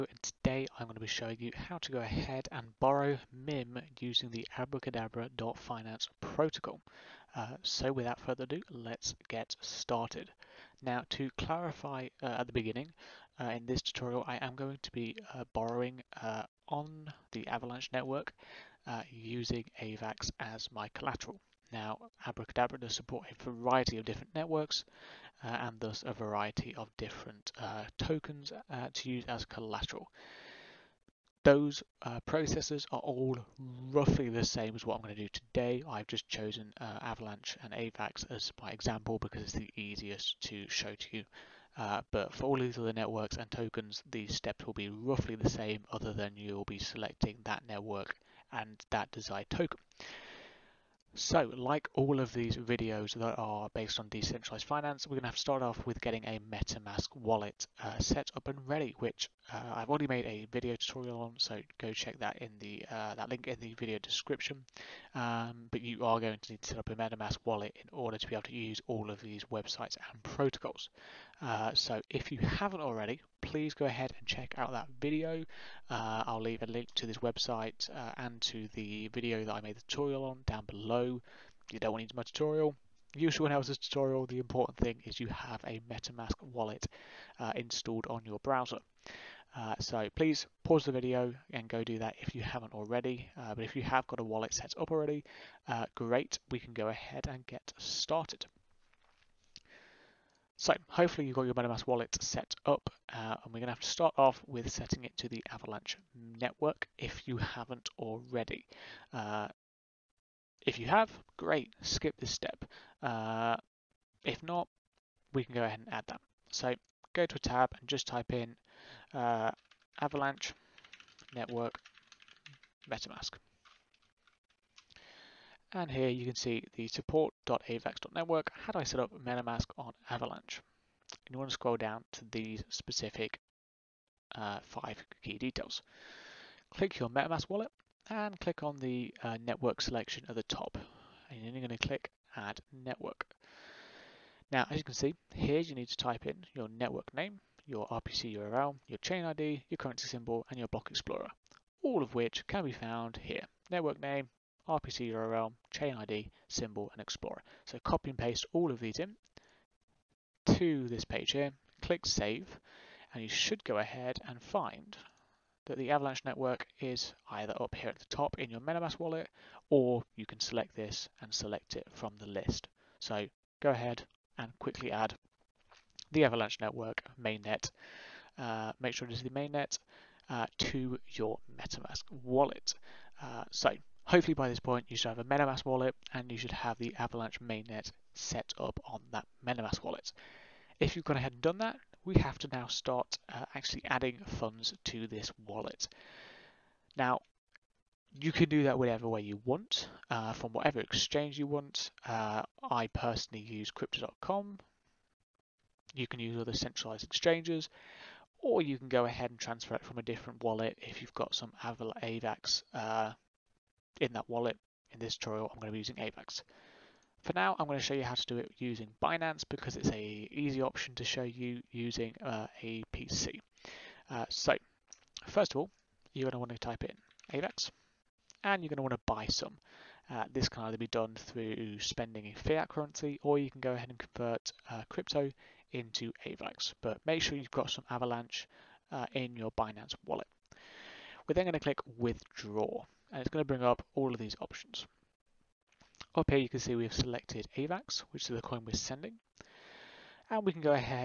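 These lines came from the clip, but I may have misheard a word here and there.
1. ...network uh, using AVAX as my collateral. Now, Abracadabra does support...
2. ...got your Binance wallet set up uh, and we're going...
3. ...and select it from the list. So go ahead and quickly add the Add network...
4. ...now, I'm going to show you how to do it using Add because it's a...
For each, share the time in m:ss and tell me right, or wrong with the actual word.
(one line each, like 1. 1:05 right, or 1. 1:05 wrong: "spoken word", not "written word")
1. 0:17 right
2. 1:41 wrong: "MetaMask", not "Binance"
3. 2:51 wrong: "Avalanche", not "Add"
4. 3:37 wrong: "Binance", not "Add".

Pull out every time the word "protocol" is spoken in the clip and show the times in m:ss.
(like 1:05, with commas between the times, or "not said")
0:06, 1:10.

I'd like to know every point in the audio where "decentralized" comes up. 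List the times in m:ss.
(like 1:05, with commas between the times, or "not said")
0:54.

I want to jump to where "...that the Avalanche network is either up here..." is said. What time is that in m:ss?
2:45.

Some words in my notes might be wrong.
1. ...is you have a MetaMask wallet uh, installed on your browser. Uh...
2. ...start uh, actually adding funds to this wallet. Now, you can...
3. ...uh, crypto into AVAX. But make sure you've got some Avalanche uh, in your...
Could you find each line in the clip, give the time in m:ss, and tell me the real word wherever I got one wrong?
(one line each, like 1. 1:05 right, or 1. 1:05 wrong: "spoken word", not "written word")
1. 1:25 right
2. 3:12 right
3. 3:54 right.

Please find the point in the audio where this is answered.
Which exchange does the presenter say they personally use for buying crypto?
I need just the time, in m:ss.
3:23.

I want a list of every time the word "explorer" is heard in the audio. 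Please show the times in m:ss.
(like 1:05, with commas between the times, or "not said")
2:30, 2:37.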